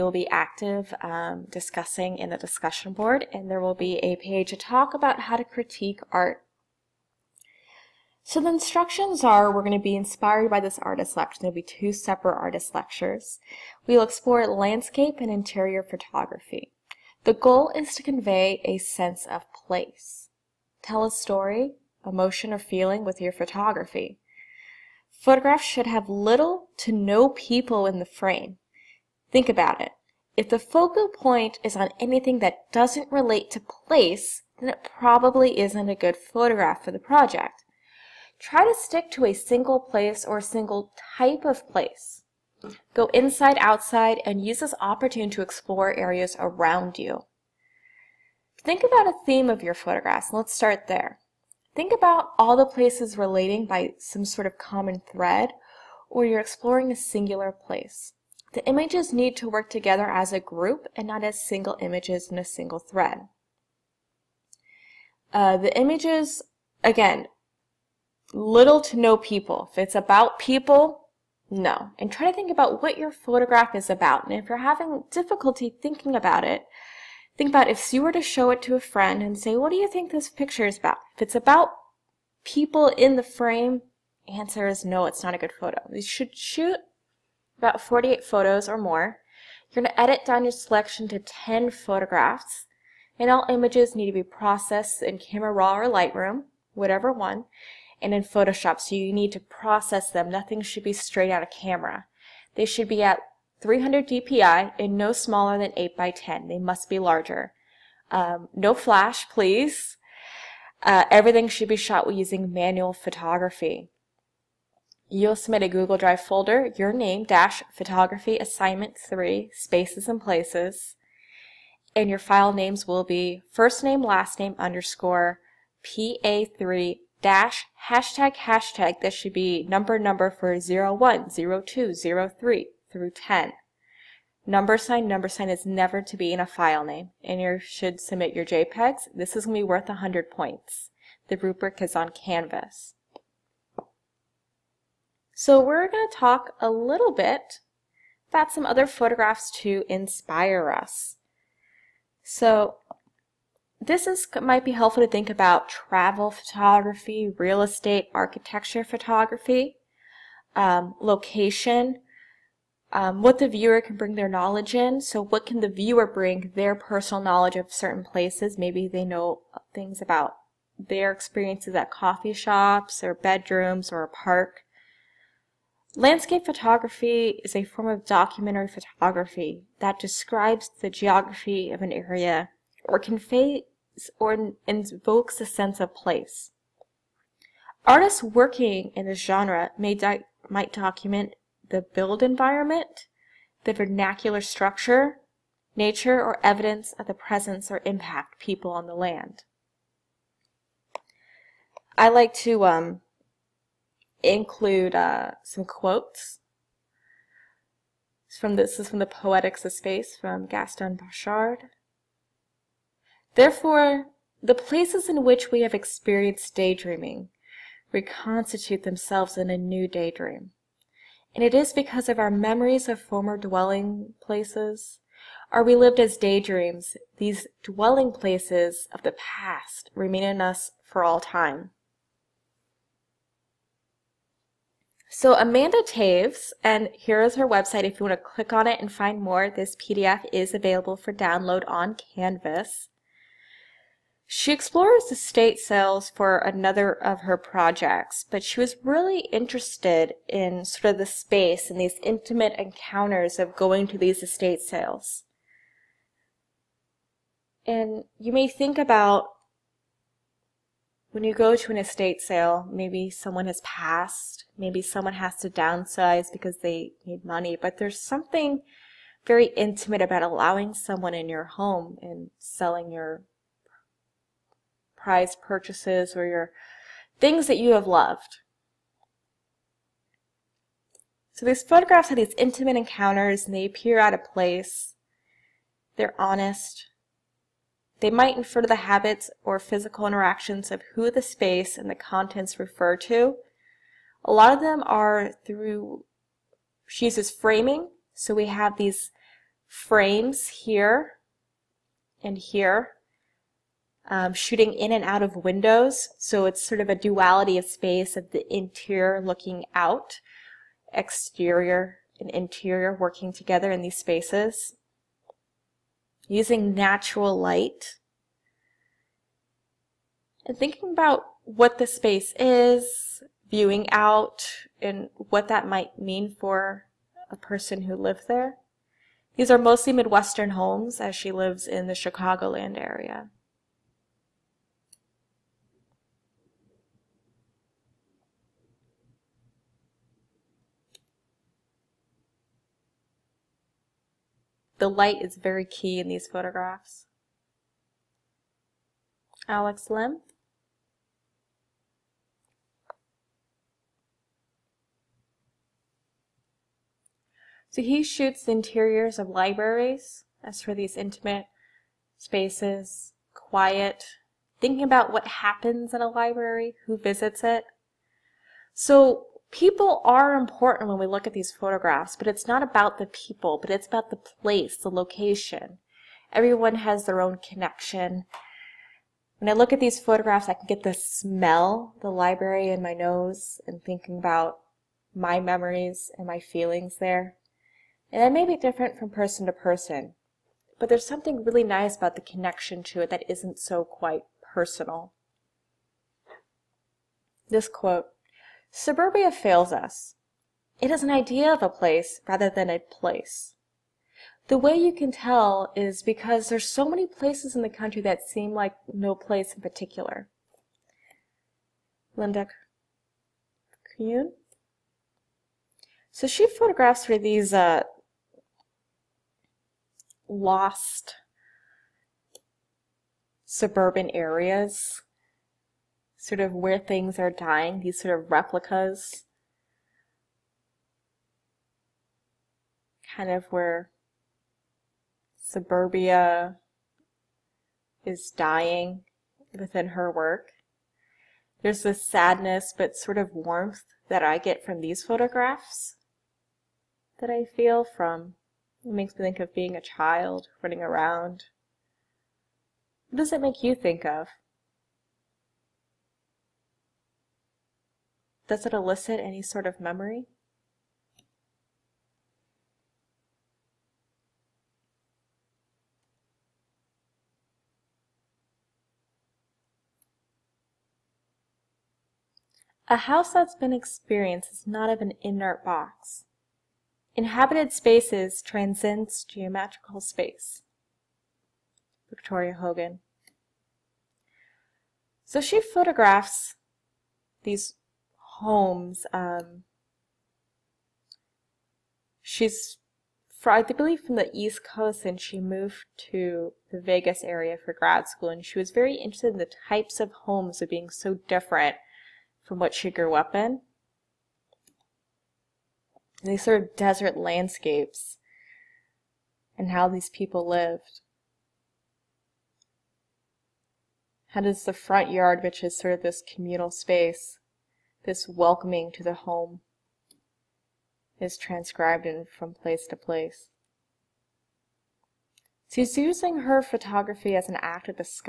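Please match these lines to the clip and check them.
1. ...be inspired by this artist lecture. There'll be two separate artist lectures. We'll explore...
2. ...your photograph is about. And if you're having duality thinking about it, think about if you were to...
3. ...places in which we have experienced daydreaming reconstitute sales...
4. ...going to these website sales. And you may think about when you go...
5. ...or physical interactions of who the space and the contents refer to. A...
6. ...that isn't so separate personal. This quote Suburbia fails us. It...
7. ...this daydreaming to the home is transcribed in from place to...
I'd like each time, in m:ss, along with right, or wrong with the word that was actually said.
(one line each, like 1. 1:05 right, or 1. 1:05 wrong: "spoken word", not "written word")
1. 0:09 right
2. 1:12 wrong: "difficulty", not "duality"
3. 3:34 wrong: "themselves", not "sales"
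4. 4:13 wrong: "estate", not "website"
5. 4:49 right
6. 6:33 wrong: "quite", not "separate"
7. 8:38 wrong: "welcoming", not "daydreaming".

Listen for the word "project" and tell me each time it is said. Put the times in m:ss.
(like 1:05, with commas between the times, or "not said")
0:36, 4:07.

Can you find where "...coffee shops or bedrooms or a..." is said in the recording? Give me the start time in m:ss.
2:51.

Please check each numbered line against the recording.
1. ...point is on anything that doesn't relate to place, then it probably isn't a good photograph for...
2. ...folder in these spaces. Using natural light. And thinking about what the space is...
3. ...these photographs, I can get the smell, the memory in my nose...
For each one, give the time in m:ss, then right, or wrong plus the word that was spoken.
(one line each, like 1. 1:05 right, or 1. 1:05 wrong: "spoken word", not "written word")
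1. 0:31 right
2. 5:13 wrong: "together", not "folder"
3. 6:19 wrong: "library", not "memory".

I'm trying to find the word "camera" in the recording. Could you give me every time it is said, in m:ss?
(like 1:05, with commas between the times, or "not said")
1:35, 1:41.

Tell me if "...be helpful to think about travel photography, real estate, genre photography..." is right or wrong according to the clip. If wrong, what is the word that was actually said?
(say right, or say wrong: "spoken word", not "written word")
wrong: "architecture", not "genre".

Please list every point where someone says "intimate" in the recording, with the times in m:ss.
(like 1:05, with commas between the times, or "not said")
4:12, 4:29, 4:42, 6:00.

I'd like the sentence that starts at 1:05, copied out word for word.
Uh, the images, again, little to no people.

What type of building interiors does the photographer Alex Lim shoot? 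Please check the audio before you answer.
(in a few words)
Libraries.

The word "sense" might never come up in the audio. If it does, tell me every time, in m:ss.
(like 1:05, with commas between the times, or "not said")
0:18, 3:05.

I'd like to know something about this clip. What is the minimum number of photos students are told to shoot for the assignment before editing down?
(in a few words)
48.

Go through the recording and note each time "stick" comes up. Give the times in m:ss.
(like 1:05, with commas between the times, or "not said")
0:38.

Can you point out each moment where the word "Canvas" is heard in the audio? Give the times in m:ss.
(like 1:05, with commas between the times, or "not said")
2:22, 4:01.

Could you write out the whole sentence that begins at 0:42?
Go inside, outside, and use this opportunity to explore areas around you.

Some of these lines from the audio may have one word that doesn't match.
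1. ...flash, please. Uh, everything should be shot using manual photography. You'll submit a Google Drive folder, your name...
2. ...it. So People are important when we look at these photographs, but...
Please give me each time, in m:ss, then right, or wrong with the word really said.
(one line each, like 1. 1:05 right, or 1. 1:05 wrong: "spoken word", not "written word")
1. 1:48 right
2. 6:07 right.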